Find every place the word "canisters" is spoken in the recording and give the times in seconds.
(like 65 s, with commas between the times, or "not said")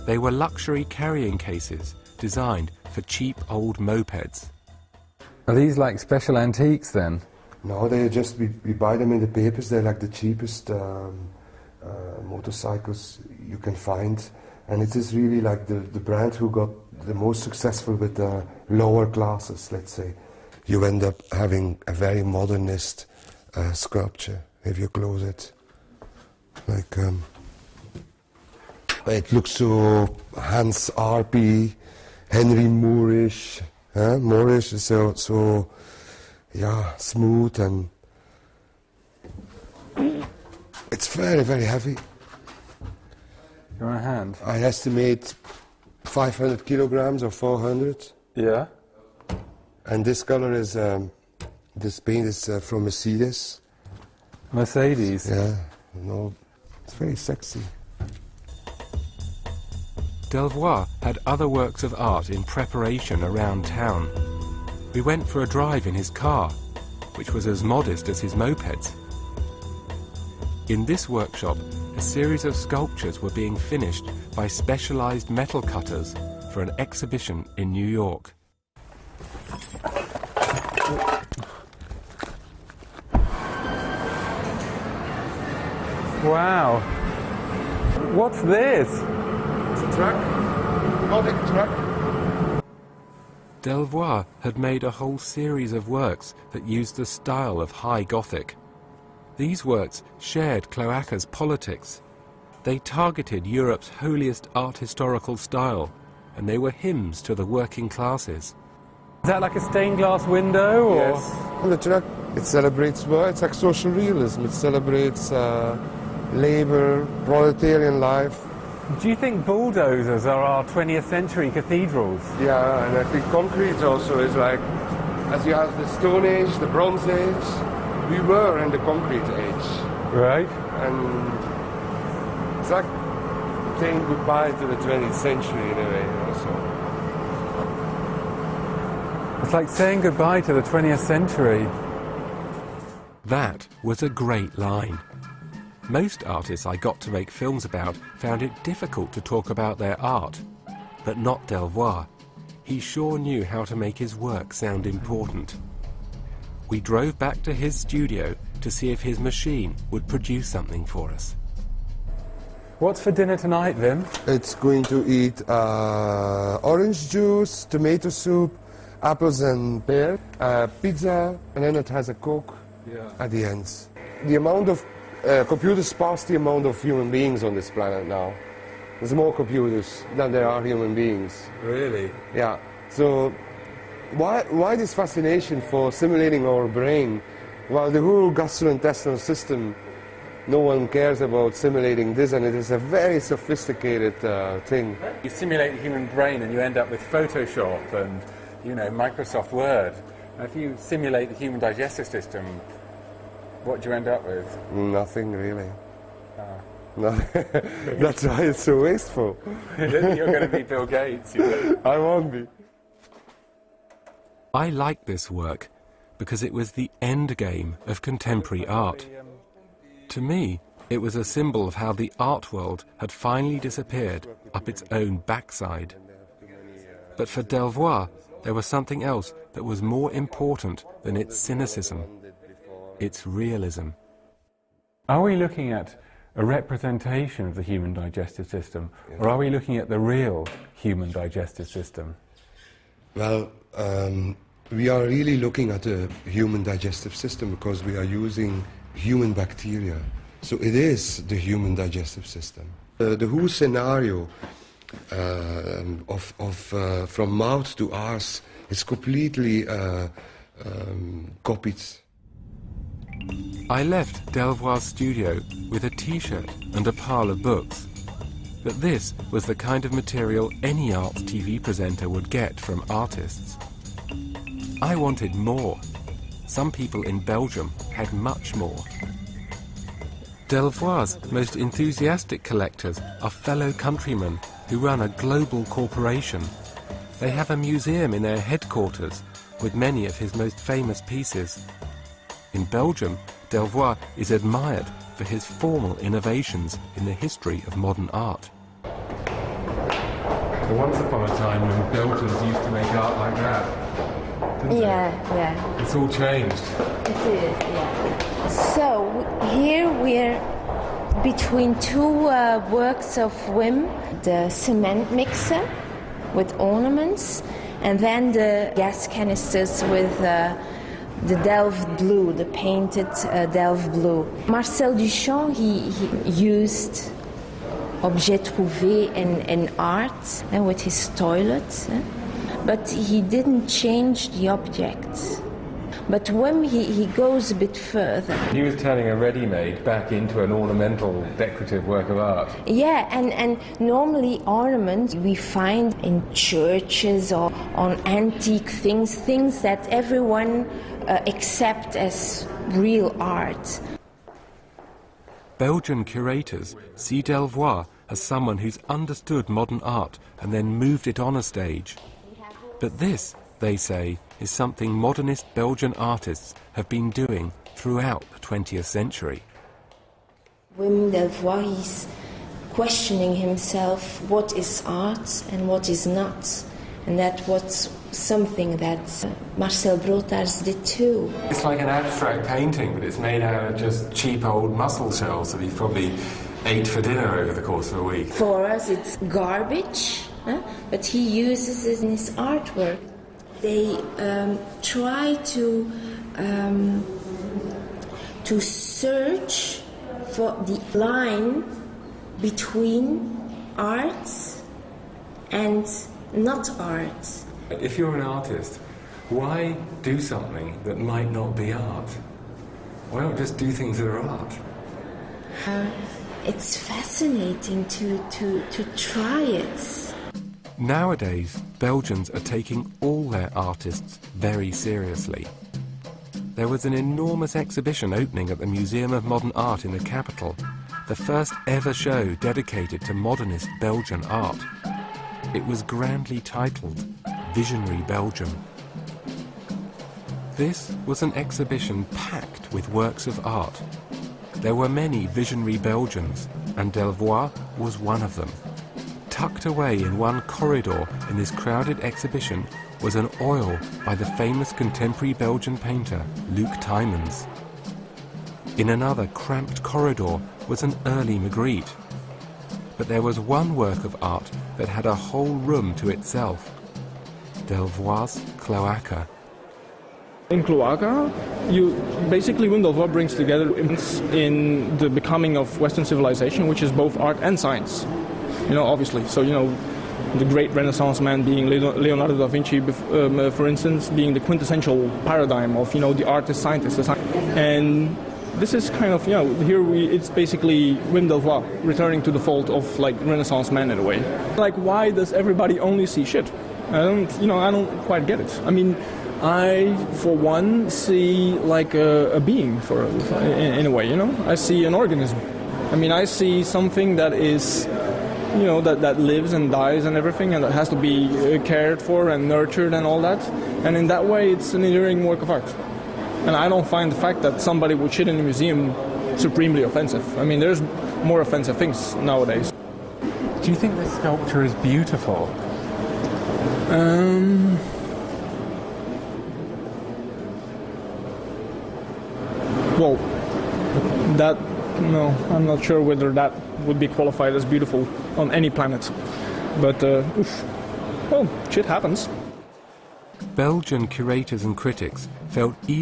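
319 s.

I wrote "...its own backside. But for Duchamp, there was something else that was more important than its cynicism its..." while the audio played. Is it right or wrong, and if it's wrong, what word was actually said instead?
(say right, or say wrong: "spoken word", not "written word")
wrong: "Delvoye", not "Duchamp".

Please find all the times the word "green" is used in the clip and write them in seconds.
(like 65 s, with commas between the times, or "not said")
not said.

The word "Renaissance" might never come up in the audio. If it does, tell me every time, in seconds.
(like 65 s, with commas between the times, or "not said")
480 s, 493 s.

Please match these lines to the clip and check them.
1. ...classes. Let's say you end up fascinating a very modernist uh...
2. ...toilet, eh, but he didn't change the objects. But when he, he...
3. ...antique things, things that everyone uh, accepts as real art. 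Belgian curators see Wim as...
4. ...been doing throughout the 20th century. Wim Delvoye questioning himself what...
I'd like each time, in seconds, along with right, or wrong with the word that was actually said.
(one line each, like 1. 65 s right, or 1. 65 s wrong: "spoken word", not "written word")
1. 19 s wrong: "having", not "fascinating"
2. 331 s right
3. 348 s wrong: "Delvoye", not "Wim"
4. 366 s right.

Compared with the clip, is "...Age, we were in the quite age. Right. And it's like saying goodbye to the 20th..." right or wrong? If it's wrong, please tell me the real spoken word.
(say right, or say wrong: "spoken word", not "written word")
wrong: "concrete", not "quite".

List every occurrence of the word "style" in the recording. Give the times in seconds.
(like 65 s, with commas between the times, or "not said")
97 s, 105 s.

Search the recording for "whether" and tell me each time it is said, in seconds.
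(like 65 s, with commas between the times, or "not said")
536 s.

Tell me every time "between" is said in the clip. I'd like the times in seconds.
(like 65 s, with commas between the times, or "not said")
311 s, 402 s.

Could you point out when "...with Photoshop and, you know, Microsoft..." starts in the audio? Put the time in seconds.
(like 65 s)
196 s.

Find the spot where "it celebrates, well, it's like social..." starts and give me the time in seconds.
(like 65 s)
112 s.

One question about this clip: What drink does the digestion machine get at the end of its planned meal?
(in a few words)
Coke.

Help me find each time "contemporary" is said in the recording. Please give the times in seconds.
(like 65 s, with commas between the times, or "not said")
218 s, 454 s.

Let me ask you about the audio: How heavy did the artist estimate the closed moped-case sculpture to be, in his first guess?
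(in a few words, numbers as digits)
500 kilograms.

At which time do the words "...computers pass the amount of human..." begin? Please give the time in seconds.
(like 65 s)
175 s.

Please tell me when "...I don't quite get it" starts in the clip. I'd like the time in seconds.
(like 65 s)
497 s.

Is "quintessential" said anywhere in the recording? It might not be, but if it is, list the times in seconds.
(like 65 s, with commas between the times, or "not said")
484 s.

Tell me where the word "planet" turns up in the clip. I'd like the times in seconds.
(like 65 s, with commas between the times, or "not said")
177 s, 538 s.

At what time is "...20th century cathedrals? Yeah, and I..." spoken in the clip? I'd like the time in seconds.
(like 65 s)
120 s.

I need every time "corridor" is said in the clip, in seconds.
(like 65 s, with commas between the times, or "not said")
450 s, 459 s.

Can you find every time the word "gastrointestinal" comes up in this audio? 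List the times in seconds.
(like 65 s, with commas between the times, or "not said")
188 s.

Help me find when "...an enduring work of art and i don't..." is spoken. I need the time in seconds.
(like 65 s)
514 s.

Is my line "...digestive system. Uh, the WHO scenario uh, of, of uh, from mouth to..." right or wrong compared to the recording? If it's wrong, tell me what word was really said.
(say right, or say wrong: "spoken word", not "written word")
right.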